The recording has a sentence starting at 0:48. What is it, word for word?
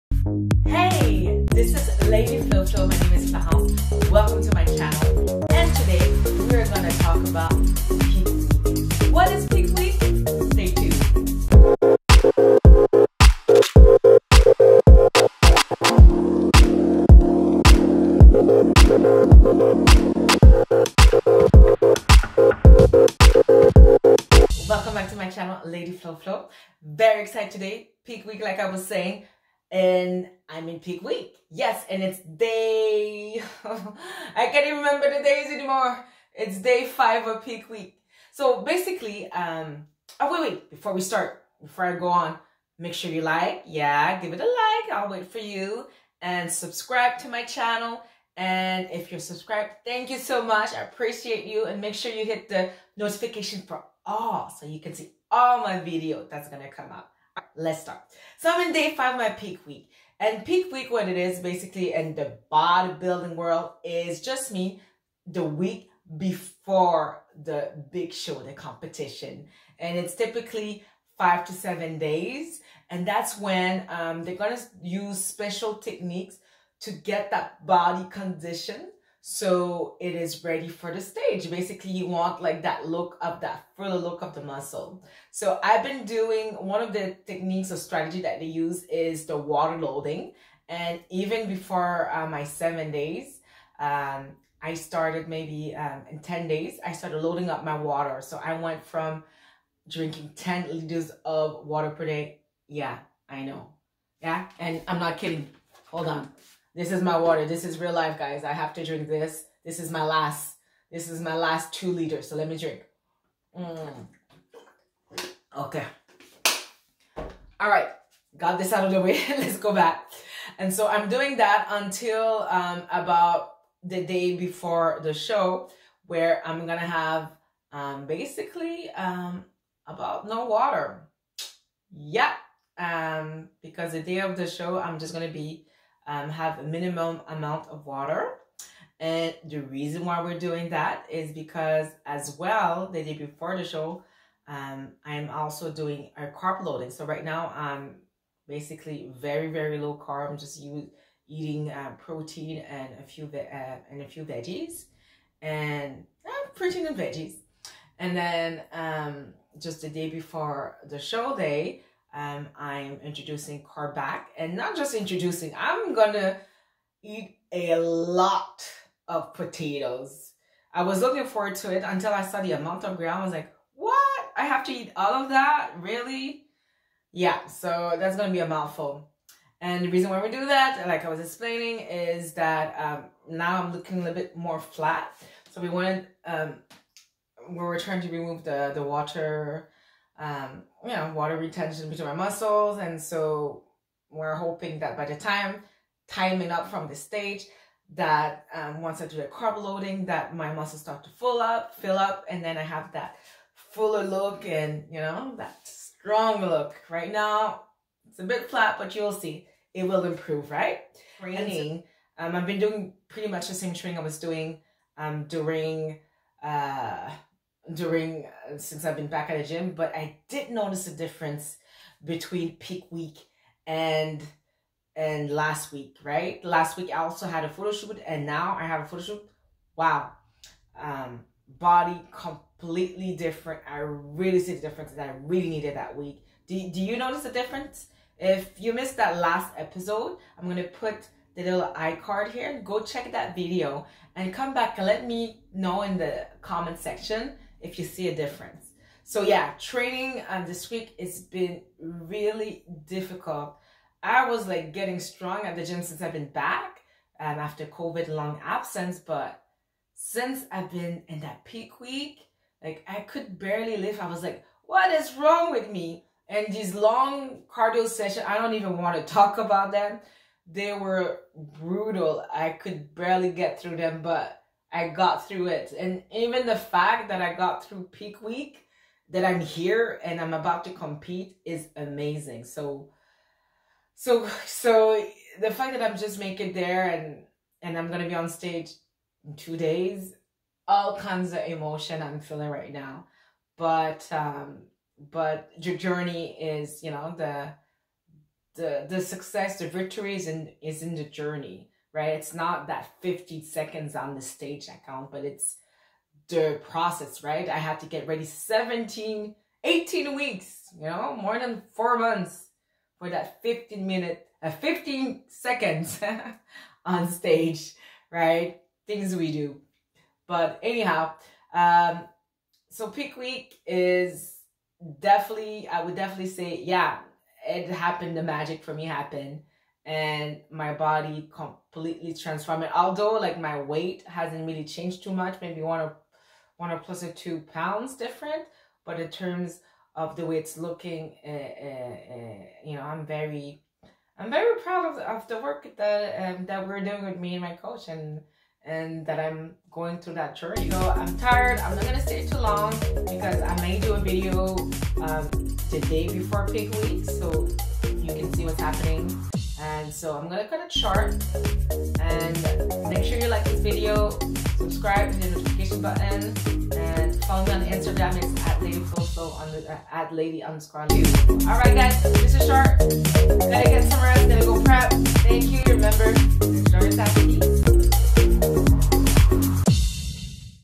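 And if you're subscribed, thank you so much.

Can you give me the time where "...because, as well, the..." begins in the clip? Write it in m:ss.
2:21.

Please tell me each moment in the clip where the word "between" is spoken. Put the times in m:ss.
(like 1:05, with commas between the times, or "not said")
3:11, 3:42.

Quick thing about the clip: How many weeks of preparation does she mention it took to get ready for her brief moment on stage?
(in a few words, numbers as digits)
17 or 18 weeks.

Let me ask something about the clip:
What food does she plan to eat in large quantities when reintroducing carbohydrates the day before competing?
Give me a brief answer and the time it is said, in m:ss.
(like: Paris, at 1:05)
Potatoes, at 2:49.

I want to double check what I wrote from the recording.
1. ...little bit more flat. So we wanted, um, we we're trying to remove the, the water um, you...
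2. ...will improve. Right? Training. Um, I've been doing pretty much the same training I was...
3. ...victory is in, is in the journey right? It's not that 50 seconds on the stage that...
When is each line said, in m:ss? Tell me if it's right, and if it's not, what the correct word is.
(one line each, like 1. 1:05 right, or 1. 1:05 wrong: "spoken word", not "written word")
1. 3:04 right
2. 3:29 right
3. 4:59 right.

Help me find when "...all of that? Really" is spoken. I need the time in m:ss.
2:54.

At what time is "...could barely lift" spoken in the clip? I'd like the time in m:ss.
4:23.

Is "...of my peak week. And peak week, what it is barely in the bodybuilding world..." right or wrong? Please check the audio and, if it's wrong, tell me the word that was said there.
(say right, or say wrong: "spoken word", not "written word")
wrong: "basically", not "barely".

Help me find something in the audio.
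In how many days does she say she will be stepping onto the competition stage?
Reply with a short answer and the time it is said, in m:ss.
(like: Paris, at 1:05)
2 days, at 4:49.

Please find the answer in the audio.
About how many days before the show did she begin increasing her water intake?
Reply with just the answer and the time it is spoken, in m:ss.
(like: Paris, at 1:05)
10 days, at 1:36.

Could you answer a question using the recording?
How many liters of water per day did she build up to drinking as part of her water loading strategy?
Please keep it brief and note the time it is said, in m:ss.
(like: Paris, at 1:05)
10 liters, at 1:40.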